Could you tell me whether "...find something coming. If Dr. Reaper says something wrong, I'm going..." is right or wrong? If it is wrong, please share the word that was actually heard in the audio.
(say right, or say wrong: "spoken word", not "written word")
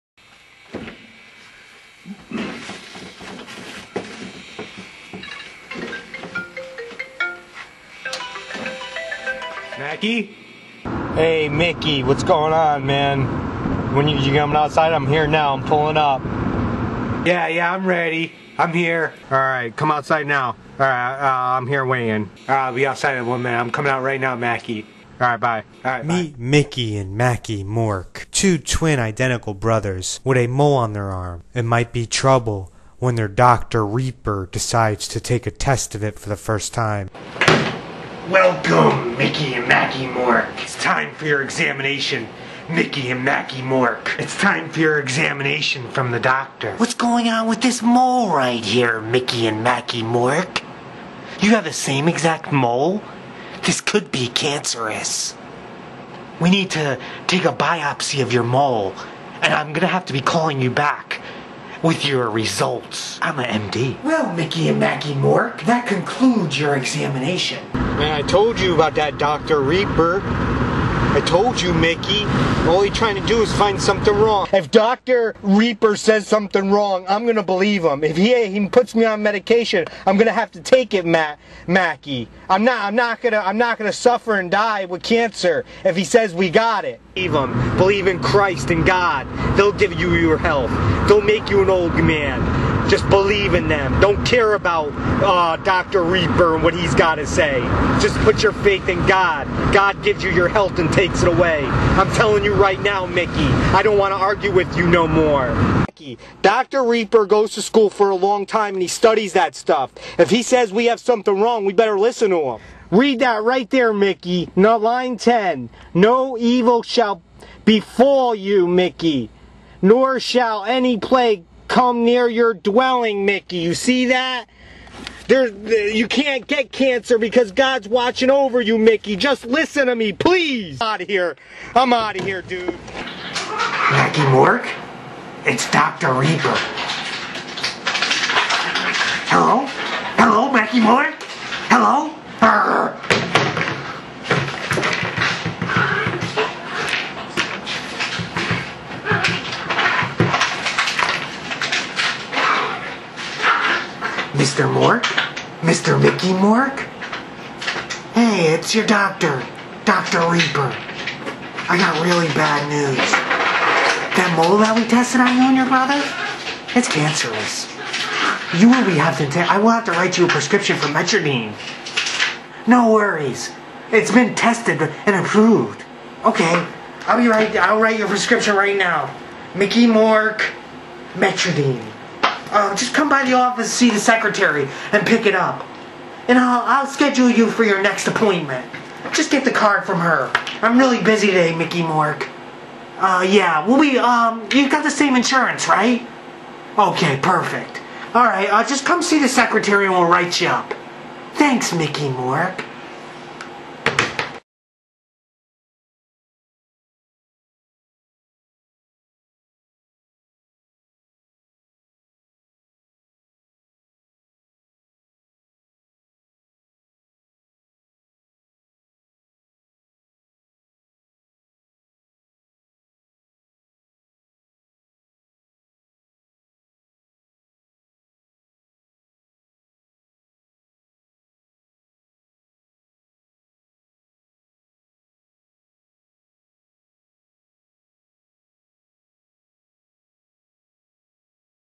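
wrong: "wrong", not "coming".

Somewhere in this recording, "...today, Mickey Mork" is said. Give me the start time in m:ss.
3:11.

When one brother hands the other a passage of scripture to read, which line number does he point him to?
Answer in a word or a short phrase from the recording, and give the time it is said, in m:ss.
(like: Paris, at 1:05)
10, at 1:54.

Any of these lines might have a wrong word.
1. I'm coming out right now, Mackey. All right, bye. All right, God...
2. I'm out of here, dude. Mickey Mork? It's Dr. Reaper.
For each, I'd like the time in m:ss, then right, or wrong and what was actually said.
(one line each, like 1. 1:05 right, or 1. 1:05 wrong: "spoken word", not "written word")
1. 0:23 wrong: "Meet", not "God"
2. 2:11 right.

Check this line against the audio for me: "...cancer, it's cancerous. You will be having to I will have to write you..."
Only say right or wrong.
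wrong.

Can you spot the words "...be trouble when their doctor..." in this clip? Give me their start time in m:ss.
0:31.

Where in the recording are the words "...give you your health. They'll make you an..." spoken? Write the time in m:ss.
1:29.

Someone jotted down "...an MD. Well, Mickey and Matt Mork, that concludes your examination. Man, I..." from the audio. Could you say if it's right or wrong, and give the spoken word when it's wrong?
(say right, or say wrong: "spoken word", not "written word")
wrong: "Mackey", not "Matt".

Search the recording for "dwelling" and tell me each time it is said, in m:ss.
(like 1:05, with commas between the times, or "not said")
2:02.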